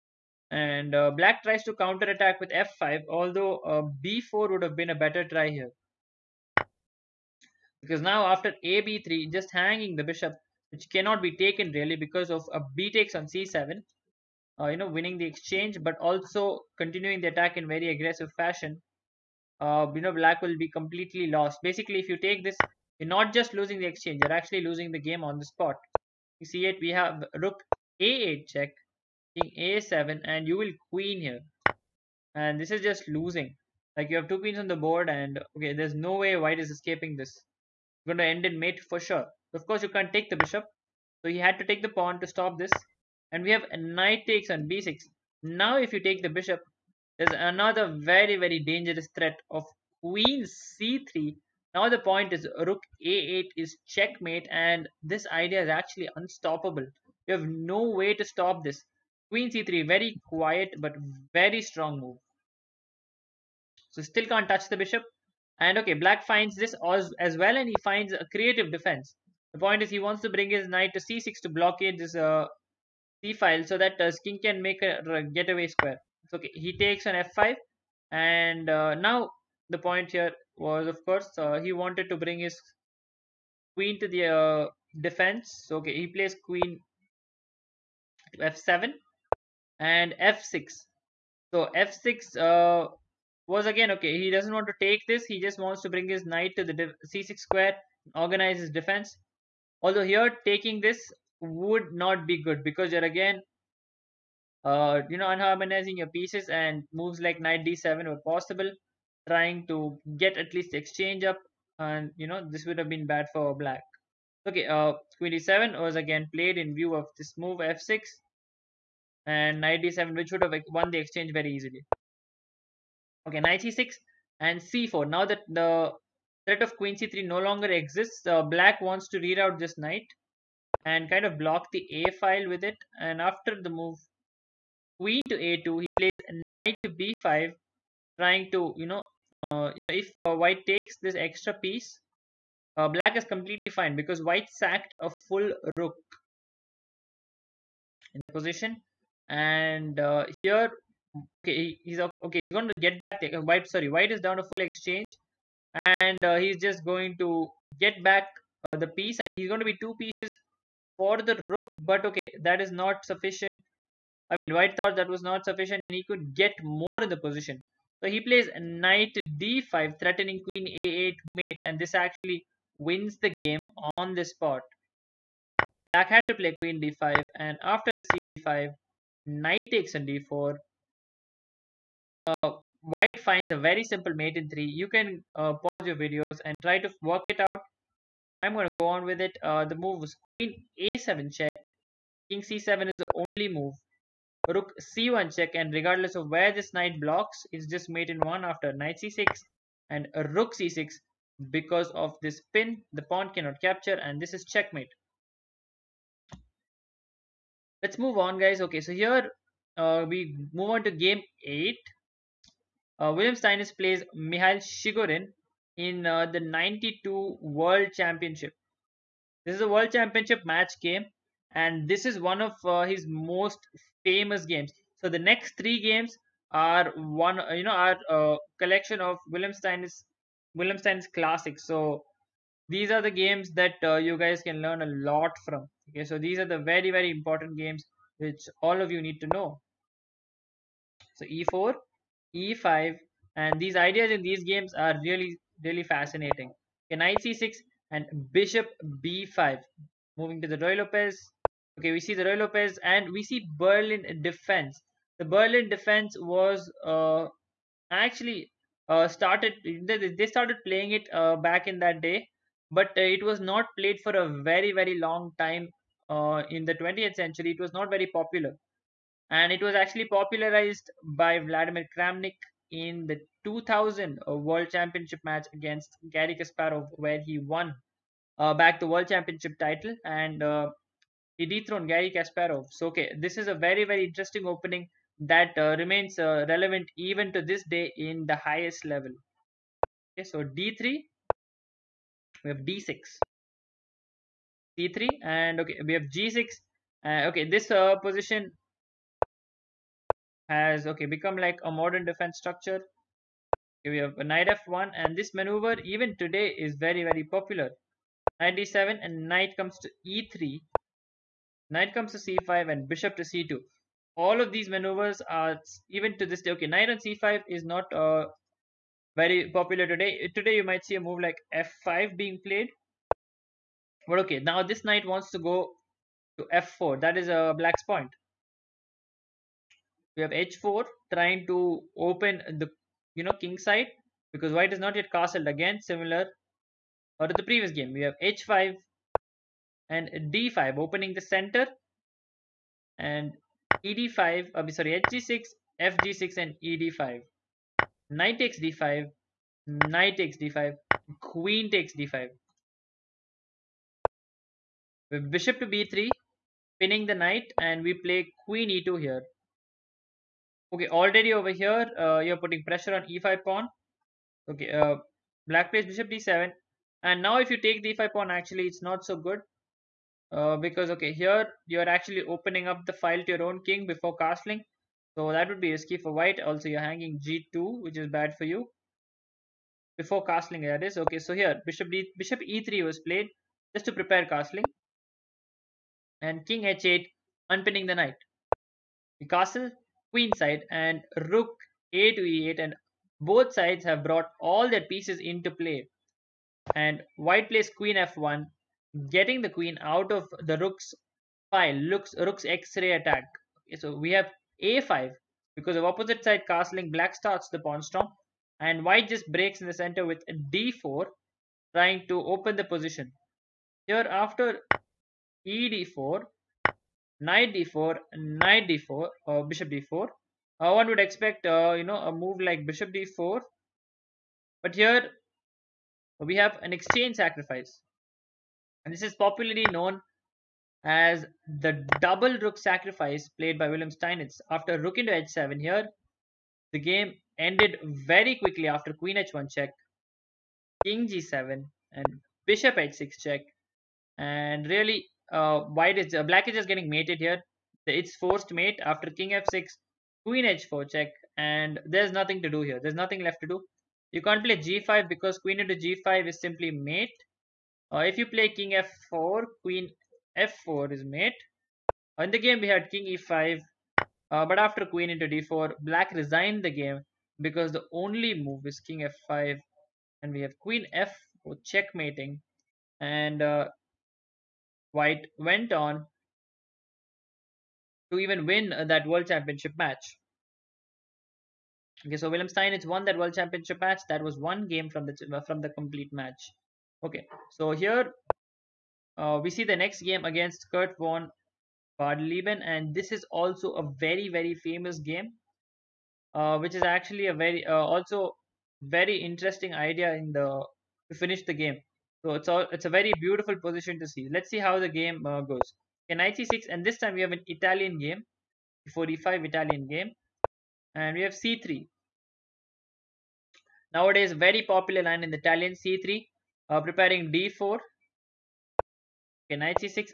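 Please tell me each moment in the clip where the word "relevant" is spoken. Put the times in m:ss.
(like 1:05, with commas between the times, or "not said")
4:46.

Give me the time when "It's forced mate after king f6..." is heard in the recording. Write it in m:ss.
7:27.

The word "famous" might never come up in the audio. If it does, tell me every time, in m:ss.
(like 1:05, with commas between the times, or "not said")
3:44, 8:14.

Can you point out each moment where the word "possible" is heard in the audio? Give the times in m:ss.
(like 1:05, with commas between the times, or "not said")
1:48.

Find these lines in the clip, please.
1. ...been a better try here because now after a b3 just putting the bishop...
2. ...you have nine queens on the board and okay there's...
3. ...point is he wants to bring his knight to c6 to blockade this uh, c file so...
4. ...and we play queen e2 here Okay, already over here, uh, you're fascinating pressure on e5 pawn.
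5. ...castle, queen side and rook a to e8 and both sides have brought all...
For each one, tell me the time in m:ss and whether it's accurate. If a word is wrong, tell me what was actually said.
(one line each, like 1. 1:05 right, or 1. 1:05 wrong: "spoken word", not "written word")
1. 0:04 wrong: "hanging", not "putting"
2. 0:34 wrong: "two", not "nine"
3. 1:09 right
4. 5:57 wrong: "putting", not "fascinating"
5. 6:29 right.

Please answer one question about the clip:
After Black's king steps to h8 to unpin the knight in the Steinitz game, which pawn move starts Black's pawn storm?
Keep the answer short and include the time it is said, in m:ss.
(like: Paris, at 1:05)
a5, at 6:44.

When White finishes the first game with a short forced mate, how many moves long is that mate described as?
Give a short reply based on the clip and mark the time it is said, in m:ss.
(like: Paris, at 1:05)
3, at 3:04.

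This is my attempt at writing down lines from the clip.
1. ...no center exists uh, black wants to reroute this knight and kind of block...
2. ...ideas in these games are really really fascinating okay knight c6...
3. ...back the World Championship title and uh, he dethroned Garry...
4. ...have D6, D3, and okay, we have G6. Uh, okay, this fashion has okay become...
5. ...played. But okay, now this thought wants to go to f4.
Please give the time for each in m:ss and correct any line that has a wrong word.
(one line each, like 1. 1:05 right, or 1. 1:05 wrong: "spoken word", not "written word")
1. 2:07 wrong: "longer", not "center"
2. 4:03 right
3. 4:38 right
4. 4:52 wrong: "position", not "fashion"
5. 5:22 wrong: "knight", not "thought".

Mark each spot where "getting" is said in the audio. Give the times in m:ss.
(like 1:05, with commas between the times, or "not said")
6:39, 7:26.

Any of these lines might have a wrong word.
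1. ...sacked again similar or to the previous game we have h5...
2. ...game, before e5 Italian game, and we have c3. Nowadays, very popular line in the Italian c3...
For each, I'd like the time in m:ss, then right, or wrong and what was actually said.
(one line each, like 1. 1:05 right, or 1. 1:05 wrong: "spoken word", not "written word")
1. 5:35 wrong: "castled", not "sacked"
2. 8:27 right.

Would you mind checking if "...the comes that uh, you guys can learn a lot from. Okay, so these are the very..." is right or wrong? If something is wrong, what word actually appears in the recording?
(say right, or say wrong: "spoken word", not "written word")
wrong: "games", not "comes".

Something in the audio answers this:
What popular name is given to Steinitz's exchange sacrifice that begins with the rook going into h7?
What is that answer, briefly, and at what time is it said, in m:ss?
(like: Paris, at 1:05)
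double rook sacrifice, at 7:12.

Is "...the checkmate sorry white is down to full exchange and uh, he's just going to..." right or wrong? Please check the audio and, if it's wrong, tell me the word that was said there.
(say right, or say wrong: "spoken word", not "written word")
wrong: "white", not "checkmate".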